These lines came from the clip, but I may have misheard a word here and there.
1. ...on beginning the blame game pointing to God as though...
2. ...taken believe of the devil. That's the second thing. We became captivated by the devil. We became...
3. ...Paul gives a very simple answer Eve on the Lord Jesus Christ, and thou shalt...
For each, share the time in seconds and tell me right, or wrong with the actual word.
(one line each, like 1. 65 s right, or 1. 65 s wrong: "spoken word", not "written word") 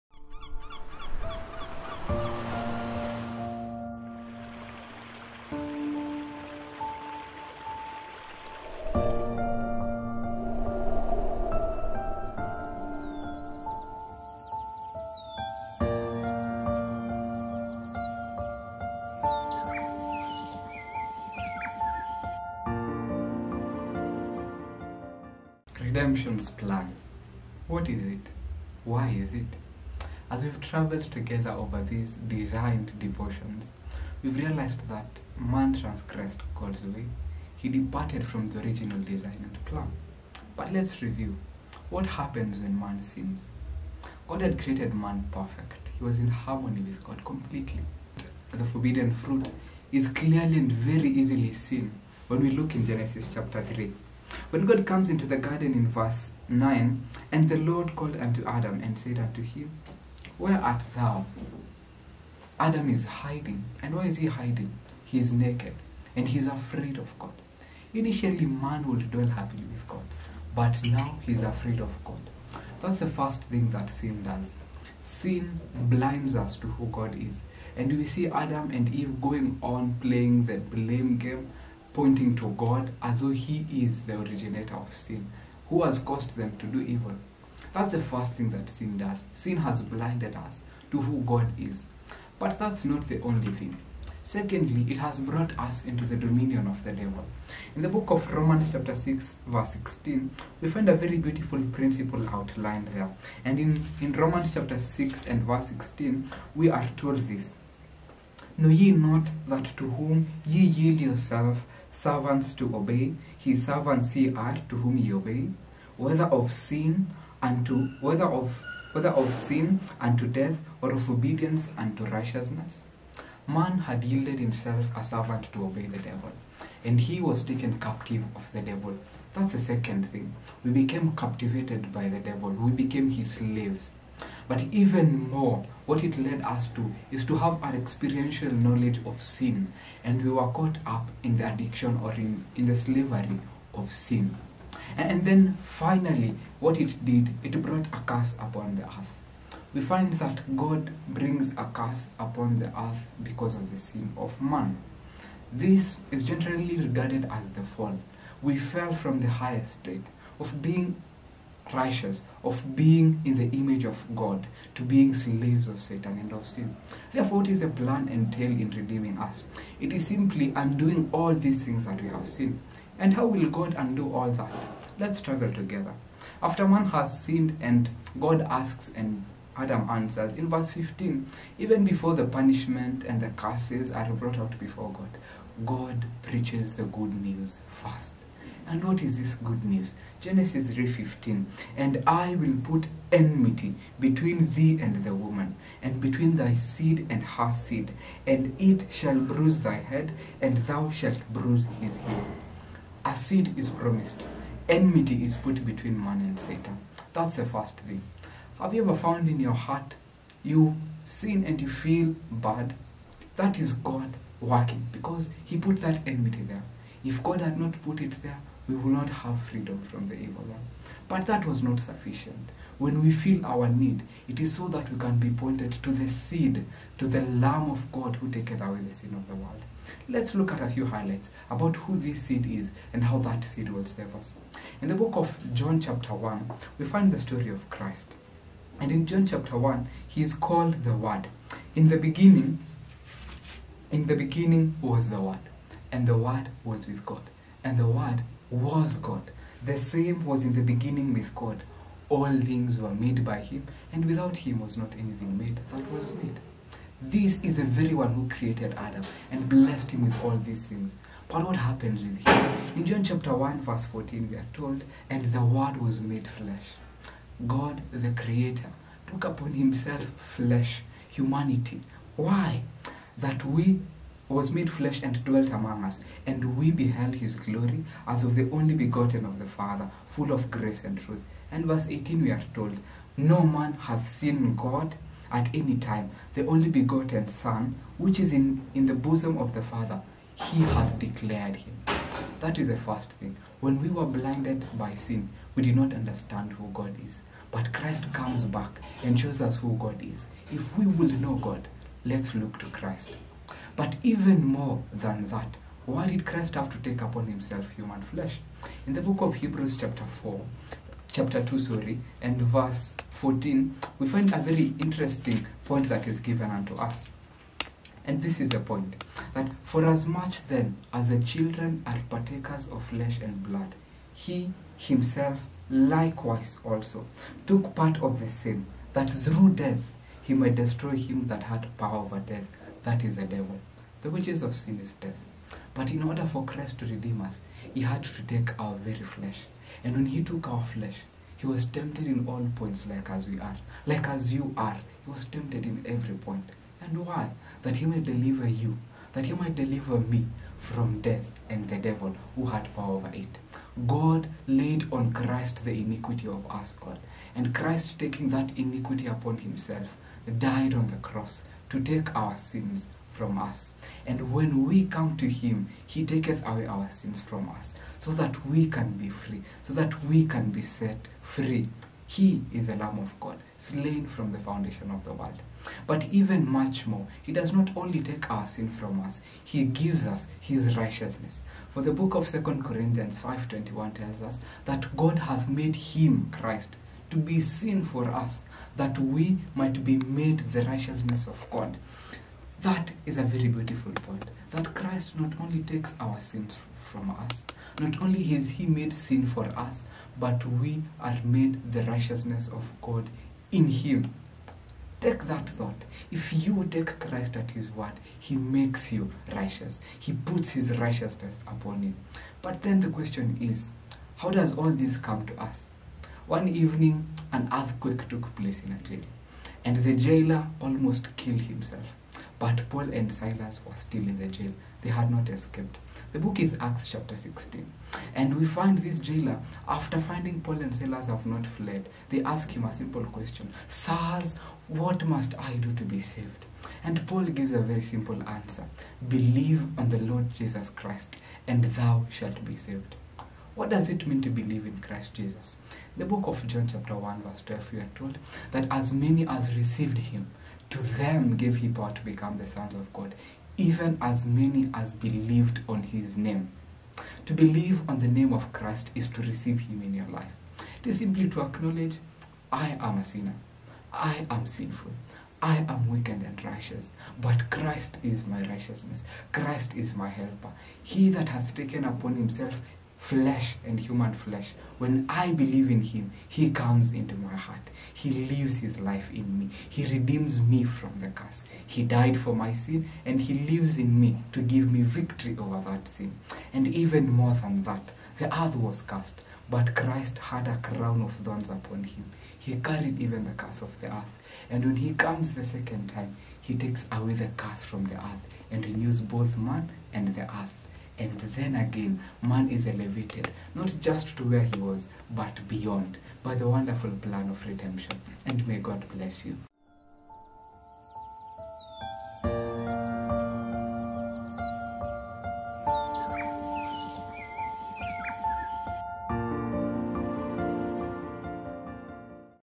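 1. 79 s wrong: "playing", not "beginning"
2. 127 s wrong: "captive", not "believe"
3. 437 s wrong: "Believe", not "Eve".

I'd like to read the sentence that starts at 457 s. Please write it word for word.
To believe on the name of Christ is to receive him in your life.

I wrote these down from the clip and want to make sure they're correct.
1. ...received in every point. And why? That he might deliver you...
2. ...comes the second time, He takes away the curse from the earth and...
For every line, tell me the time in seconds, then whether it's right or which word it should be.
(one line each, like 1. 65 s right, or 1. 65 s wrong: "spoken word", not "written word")
1. 345 s wrong: "tempted", not "received"
2. 494 s right.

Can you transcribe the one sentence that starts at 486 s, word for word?
And even more than that, the earth was cursed, but Christ had a crown of thorns upon Him.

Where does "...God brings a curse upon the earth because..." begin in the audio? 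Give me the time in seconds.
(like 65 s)
150 s.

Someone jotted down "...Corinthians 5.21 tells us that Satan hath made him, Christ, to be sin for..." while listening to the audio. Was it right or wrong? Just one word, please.
wrong.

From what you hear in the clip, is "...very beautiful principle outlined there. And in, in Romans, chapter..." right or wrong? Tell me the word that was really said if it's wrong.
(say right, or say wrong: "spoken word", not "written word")
right.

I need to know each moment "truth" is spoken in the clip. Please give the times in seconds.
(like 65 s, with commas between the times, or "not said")
280 s.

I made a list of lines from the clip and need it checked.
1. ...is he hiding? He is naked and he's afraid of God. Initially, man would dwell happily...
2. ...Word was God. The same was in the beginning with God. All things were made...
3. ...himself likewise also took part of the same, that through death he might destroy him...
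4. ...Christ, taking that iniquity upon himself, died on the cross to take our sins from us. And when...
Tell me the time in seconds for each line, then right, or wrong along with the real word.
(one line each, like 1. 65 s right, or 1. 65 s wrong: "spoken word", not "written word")
1. 64 s right
2. 247 s right
3. 324 s right
4. 357 s right.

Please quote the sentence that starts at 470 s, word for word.
He that hath taken upon himself flesh and human flesh.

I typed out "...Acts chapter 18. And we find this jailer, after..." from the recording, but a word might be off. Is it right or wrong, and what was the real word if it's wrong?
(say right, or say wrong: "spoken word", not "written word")
wrong: "16", not "18".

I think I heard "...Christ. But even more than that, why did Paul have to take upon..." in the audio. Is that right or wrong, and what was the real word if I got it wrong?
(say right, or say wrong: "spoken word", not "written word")
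wrong: "Christ", not "Paul".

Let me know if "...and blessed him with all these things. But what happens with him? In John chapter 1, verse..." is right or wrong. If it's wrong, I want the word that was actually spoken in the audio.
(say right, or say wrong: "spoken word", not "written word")
right.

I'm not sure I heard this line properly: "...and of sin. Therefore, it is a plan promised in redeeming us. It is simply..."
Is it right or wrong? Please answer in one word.
wrong.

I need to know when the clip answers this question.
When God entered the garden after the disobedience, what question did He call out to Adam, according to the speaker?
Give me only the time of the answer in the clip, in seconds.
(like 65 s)
60 s.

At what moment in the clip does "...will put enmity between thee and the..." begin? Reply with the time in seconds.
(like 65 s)
192 s.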